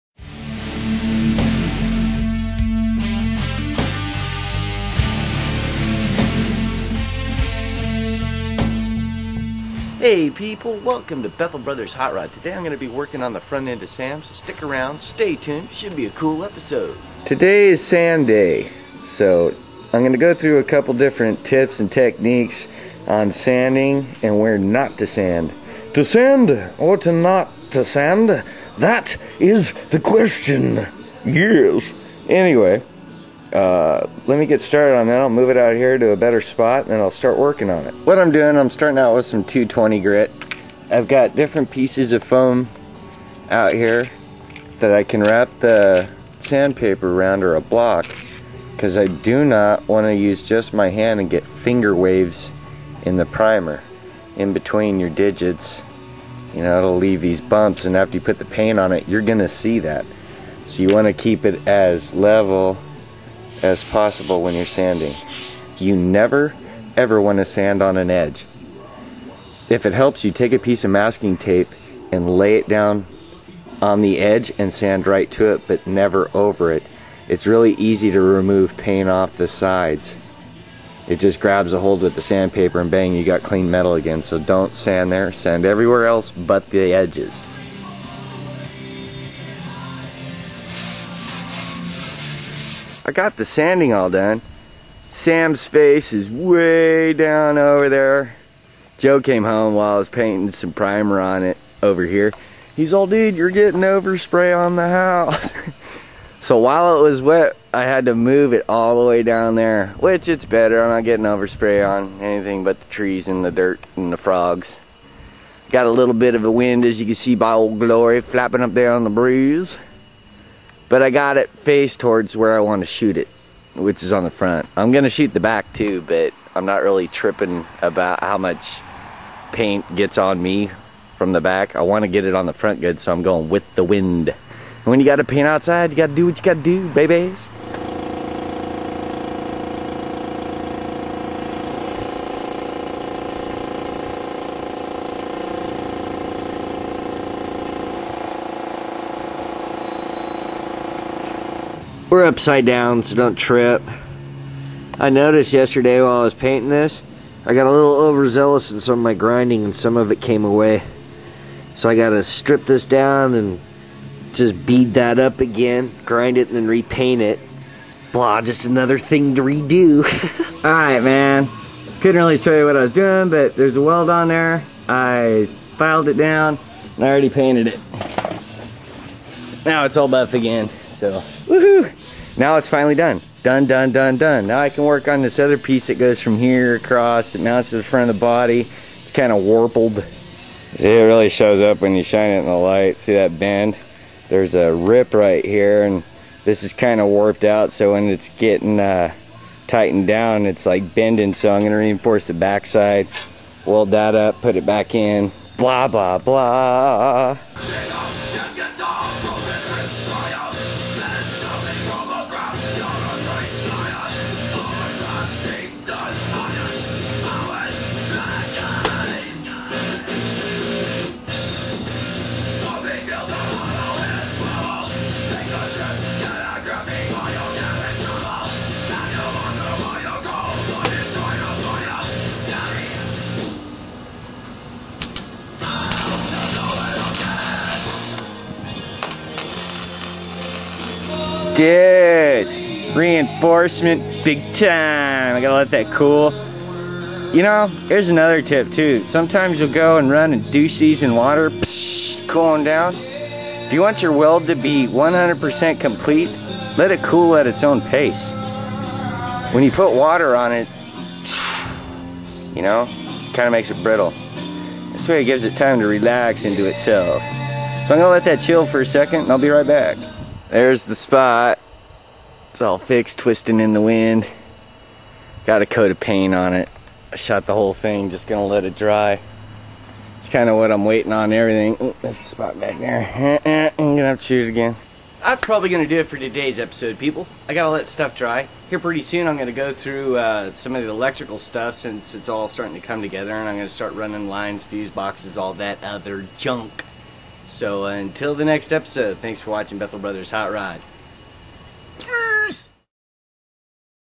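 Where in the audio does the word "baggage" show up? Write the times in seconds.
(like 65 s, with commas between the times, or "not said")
not said.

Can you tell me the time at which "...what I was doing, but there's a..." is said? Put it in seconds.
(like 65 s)
172 s.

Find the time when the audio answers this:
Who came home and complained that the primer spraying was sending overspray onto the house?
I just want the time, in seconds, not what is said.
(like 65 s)
98 s.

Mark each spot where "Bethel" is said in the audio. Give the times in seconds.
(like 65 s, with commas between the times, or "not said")
11 s, 299 s.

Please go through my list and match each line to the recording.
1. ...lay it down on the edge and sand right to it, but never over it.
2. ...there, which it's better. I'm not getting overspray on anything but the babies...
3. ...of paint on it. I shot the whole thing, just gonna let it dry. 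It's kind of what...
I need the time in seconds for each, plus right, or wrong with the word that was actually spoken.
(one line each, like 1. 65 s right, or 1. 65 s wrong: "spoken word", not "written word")
1. 72 s right
2. 109 s wrong: "trees", not "babies"
3. 275 s right.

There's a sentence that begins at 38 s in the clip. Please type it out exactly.
What I'm doing, I'm starting out with some 220 grit.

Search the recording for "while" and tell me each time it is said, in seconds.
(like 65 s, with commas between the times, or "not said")
99 s, 106 s, 156 s.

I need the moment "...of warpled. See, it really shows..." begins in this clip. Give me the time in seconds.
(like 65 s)
189 s.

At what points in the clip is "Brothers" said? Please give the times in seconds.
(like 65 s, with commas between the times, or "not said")
11 s, 299 s.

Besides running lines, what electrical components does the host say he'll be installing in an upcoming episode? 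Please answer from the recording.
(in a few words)
Fuse boxes.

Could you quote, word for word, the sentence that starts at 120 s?
But I got it faced towards where I want to shoot it, which is on the front.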